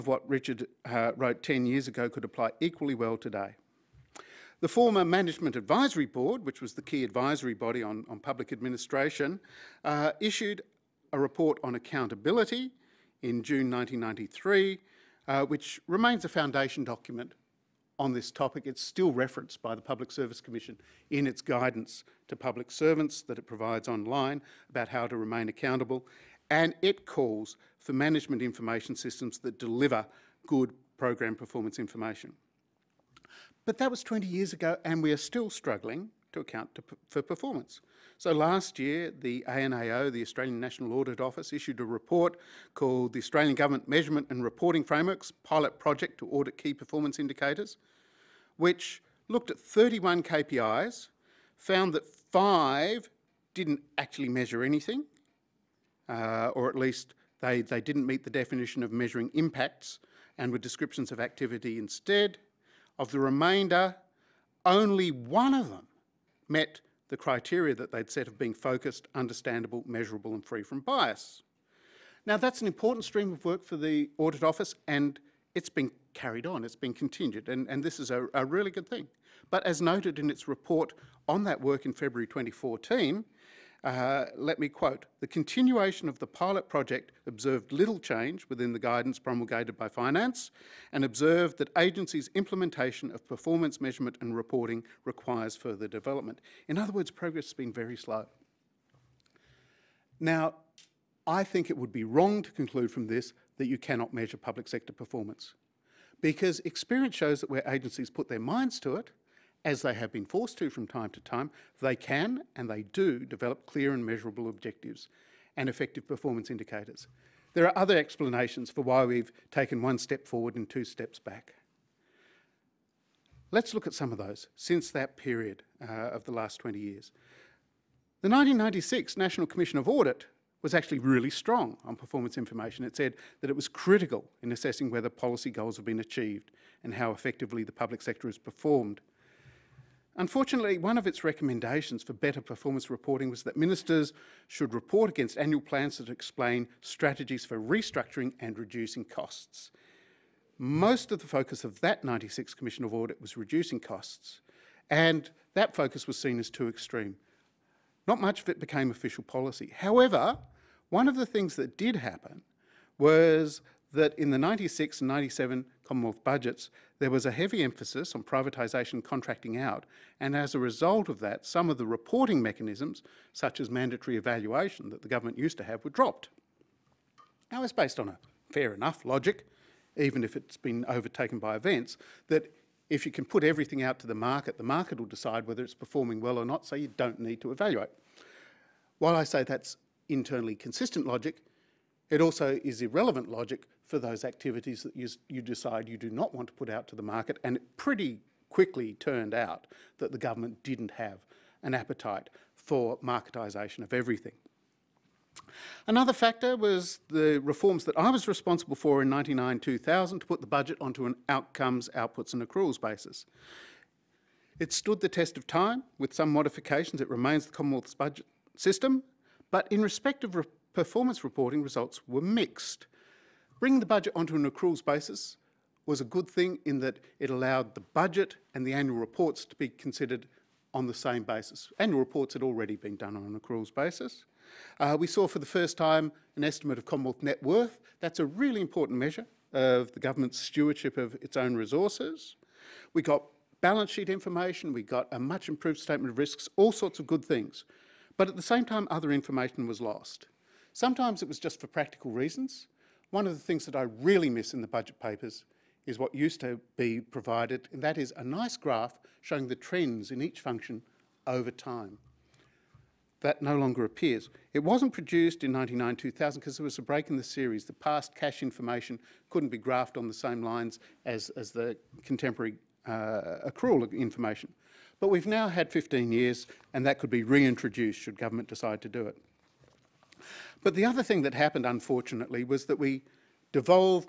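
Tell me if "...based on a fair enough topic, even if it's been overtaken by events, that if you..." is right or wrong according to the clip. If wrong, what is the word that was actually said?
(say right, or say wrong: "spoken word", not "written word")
wrong: "logic", not "topic".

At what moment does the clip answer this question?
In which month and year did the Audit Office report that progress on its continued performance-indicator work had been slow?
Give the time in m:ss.
1:21.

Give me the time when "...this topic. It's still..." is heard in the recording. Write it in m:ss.
0:18.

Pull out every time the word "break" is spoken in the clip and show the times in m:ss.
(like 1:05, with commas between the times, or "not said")
4:26.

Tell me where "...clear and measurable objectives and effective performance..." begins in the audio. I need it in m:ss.
1:53.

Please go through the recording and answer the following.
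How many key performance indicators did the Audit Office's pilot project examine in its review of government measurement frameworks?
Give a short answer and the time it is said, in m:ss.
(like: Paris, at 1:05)
31, at 0:49.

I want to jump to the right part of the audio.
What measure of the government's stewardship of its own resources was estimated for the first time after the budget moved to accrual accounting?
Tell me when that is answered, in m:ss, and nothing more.
3:56.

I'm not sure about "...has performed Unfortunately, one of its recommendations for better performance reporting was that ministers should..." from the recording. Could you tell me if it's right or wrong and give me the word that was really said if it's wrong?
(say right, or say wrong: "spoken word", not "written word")
right.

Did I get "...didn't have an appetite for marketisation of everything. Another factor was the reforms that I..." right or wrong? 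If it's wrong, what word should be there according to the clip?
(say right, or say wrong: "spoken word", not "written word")
right.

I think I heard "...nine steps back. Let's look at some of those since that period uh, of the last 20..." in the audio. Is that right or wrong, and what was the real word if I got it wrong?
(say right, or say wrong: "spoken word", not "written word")
wrong: "two", not "nine".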